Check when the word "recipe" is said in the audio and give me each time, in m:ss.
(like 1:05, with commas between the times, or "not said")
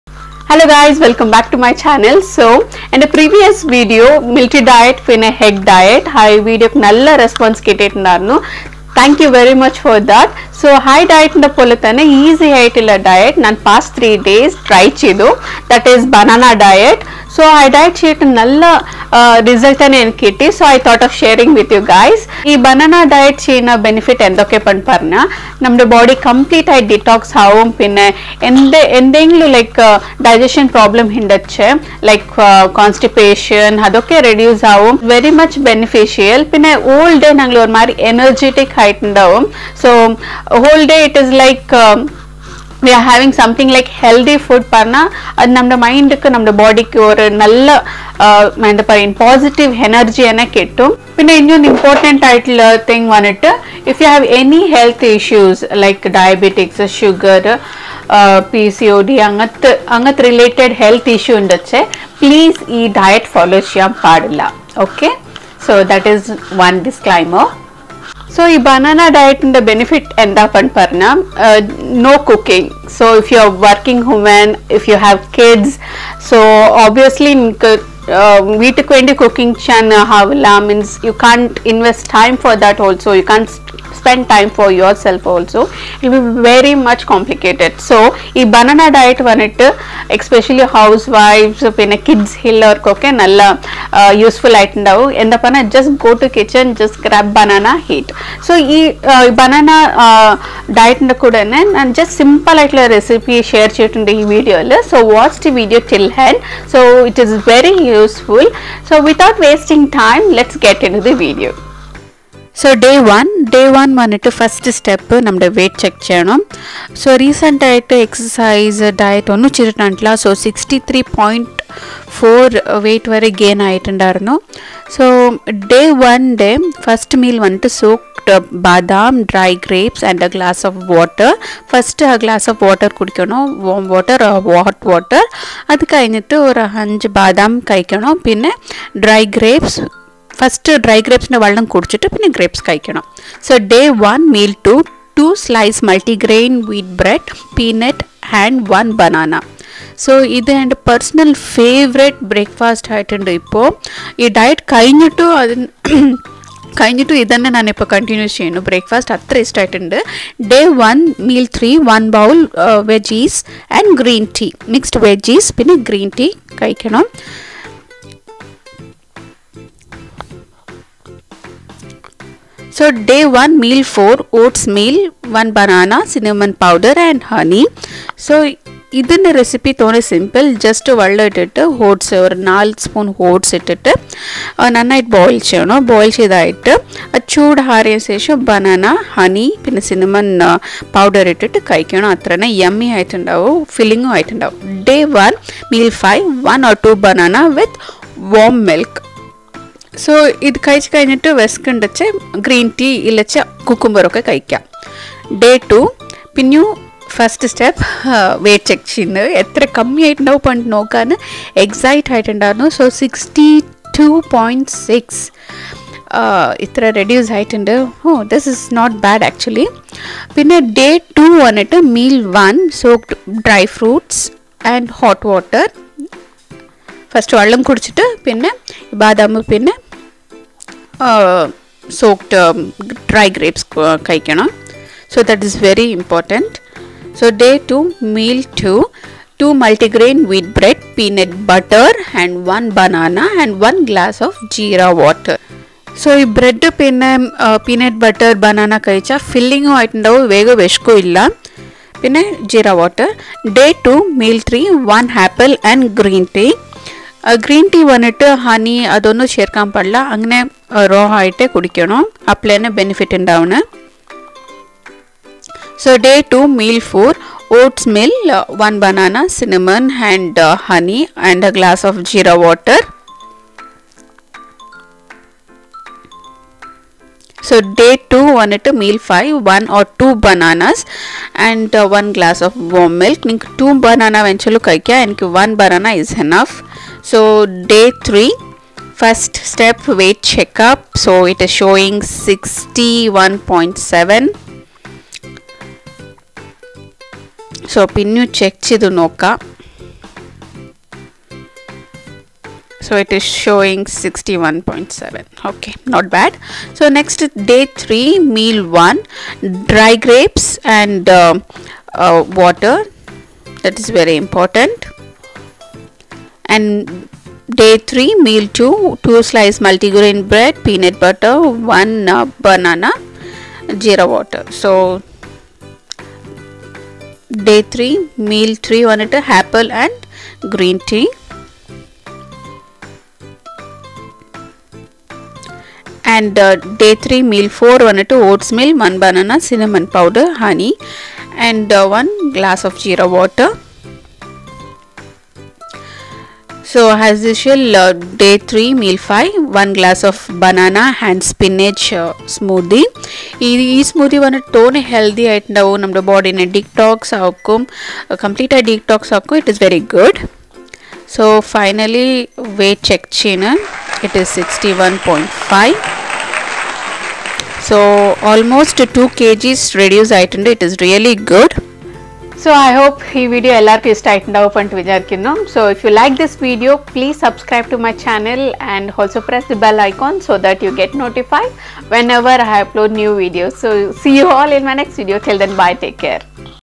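1:42.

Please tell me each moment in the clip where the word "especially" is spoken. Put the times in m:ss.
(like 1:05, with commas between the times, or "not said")
1:30.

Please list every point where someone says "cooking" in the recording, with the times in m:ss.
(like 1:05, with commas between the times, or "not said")
1:12, 1:19, 1:32.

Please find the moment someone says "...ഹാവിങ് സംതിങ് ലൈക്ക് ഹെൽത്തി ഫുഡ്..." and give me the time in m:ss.
0:43.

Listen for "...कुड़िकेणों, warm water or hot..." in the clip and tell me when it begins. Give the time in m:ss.
2:12.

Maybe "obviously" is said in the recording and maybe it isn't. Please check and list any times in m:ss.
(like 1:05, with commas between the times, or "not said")
1:16.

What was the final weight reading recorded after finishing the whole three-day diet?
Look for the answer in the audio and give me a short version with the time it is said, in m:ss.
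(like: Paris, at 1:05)
61.5, at 6:04.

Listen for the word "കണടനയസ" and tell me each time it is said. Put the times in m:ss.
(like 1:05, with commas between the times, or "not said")
2:37.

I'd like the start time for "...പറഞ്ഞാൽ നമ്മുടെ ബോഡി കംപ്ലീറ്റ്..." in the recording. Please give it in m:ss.
0:24.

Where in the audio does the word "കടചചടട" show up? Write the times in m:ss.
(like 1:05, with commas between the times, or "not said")
2:21, 3:47.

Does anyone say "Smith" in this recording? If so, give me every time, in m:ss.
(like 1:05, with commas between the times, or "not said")
not said.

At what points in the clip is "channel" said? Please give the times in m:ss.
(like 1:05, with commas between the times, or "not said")
0:01, 6:17.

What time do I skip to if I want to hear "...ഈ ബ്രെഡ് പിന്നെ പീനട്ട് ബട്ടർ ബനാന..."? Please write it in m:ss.
4:06.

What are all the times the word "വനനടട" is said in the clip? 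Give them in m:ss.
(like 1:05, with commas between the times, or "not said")
0:53, 3:41.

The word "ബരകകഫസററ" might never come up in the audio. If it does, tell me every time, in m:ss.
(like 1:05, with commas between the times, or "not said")
2:32, 2:38.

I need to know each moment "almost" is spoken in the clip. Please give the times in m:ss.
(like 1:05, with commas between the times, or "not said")
6:08.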